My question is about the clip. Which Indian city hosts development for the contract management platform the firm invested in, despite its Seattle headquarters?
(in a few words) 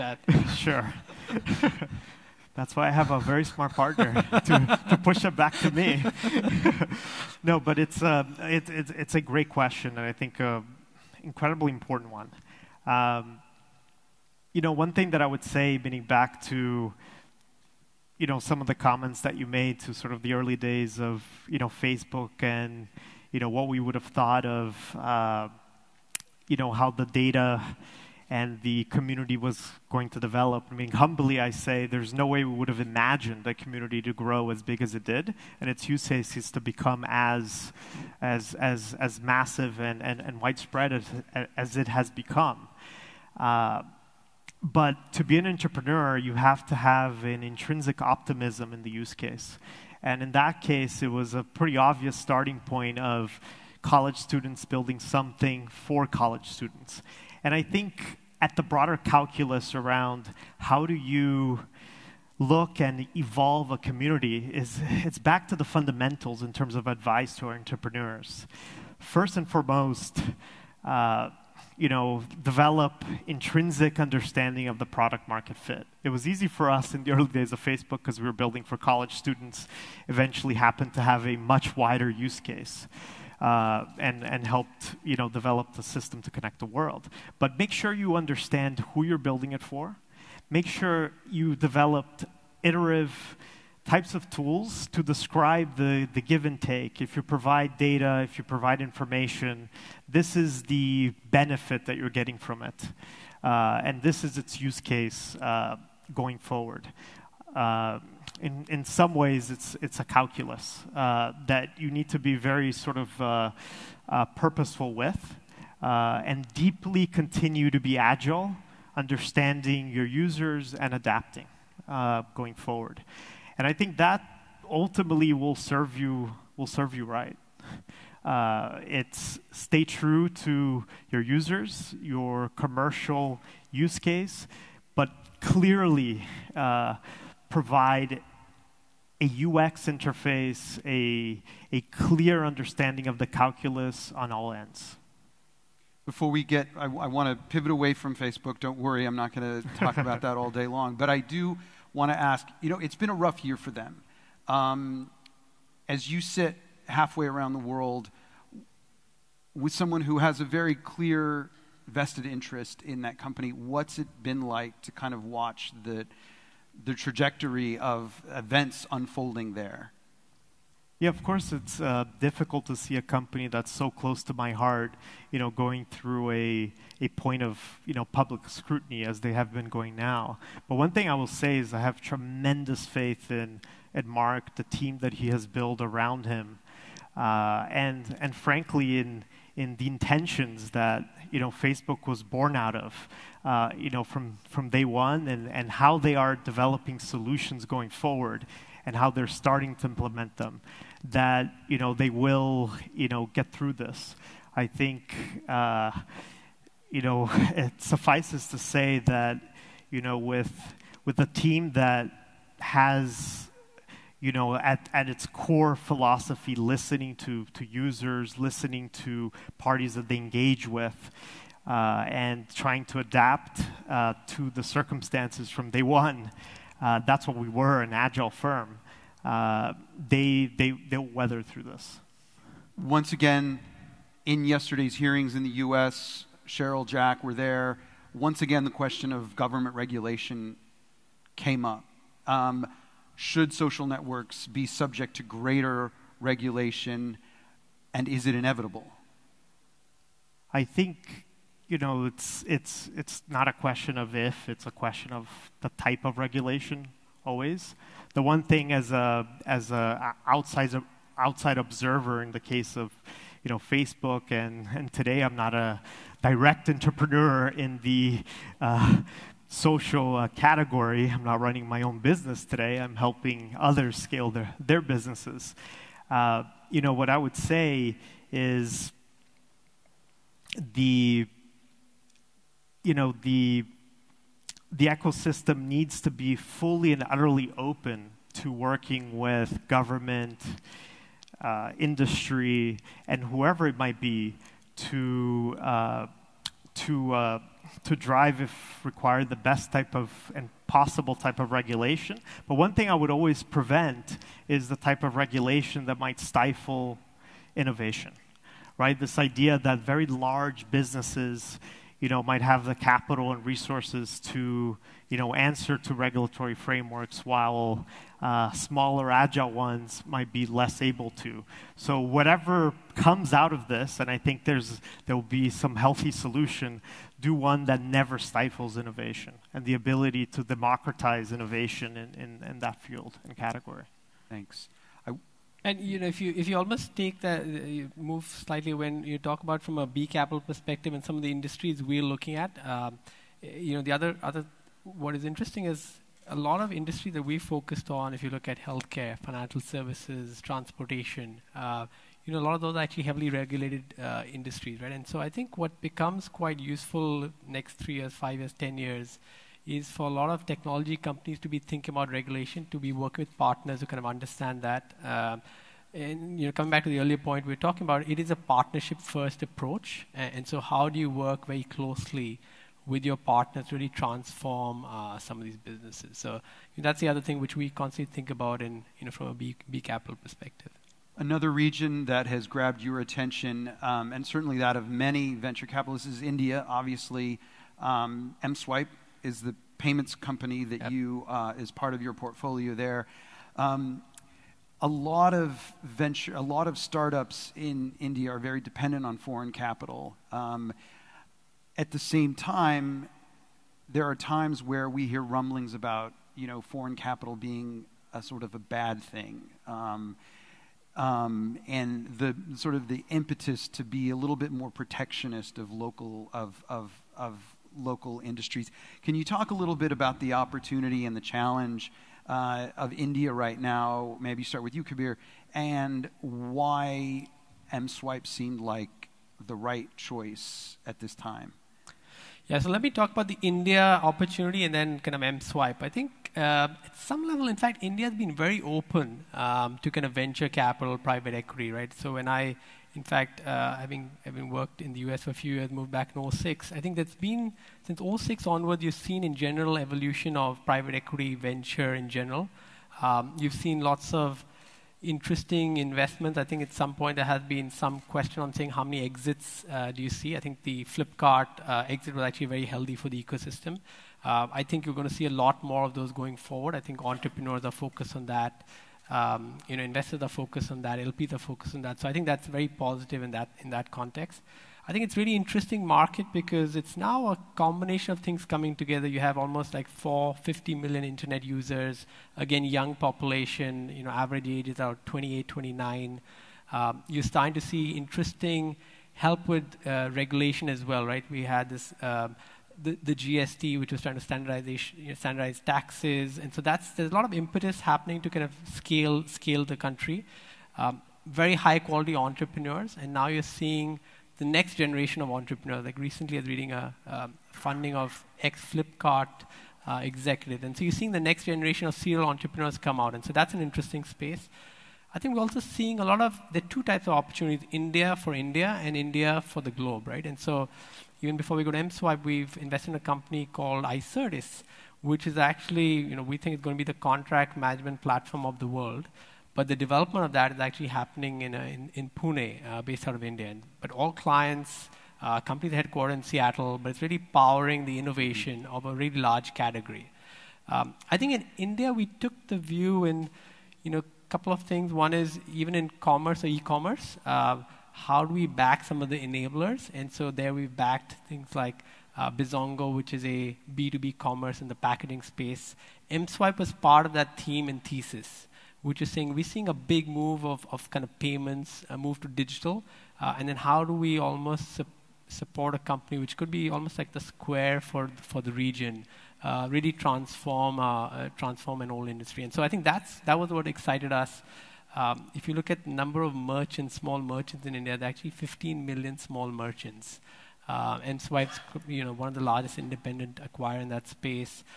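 Pune.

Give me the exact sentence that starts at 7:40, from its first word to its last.
I think the Flipkart uh, exit was actually very healthy for the ecosystem.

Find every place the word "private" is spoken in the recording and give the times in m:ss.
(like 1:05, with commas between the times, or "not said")
7:20, 7:30.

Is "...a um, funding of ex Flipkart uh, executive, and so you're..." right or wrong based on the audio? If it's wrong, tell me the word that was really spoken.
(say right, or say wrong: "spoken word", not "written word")
right.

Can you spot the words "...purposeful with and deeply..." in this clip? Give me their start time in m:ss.
1:54.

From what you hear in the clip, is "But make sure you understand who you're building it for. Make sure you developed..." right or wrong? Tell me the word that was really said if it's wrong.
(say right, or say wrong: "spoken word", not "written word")
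right.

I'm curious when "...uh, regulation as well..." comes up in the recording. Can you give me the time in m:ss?
8:09.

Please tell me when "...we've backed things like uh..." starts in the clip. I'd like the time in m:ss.
9:10.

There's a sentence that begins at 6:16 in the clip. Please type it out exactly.
So that's the other thing which we constantly think about, in you know, from a B, B capital perspective.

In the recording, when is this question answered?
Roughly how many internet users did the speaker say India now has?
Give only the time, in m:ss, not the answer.
7:59.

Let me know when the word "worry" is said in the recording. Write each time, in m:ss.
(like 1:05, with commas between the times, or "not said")
2:28.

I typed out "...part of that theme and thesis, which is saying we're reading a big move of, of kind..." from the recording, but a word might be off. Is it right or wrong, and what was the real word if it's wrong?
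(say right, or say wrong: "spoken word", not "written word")
wrong: "seeing", not "reading".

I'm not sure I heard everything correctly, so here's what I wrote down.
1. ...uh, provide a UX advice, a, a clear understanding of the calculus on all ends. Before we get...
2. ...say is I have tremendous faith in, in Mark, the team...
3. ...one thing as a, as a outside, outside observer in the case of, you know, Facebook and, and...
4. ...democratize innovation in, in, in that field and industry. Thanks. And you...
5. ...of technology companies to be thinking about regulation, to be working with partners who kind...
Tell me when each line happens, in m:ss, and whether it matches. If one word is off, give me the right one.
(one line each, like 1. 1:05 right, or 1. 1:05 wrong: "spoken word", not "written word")
1. 2:16 wrong: "interface", not "advice"
2. 3:01 right
3. 4:18 right
4. 5:30 wrong: "category", not "industry"
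5. 6:00 right.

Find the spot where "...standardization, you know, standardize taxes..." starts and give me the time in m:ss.
8:14.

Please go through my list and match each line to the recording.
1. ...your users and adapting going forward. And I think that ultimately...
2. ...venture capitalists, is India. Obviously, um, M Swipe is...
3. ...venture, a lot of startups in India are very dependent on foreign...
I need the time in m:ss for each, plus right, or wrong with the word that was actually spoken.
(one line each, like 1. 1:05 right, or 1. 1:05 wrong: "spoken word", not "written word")
1. 1:59 right
2. 6:25 right
3. 6:35 right.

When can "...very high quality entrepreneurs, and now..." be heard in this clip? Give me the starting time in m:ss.
8:21.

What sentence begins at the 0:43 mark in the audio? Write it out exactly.
Uh, but to be an entrepreneur, you have to have an intrinsic optimism in the use case.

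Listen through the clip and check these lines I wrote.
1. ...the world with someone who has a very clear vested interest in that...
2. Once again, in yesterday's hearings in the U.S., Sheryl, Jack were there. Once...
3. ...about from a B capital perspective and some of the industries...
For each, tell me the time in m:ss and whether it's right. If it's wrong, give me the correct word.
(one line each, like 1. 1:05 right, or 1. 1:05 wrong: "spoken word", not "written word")
1. 2:37 right
2. 3:52 right
3. 5:39 right.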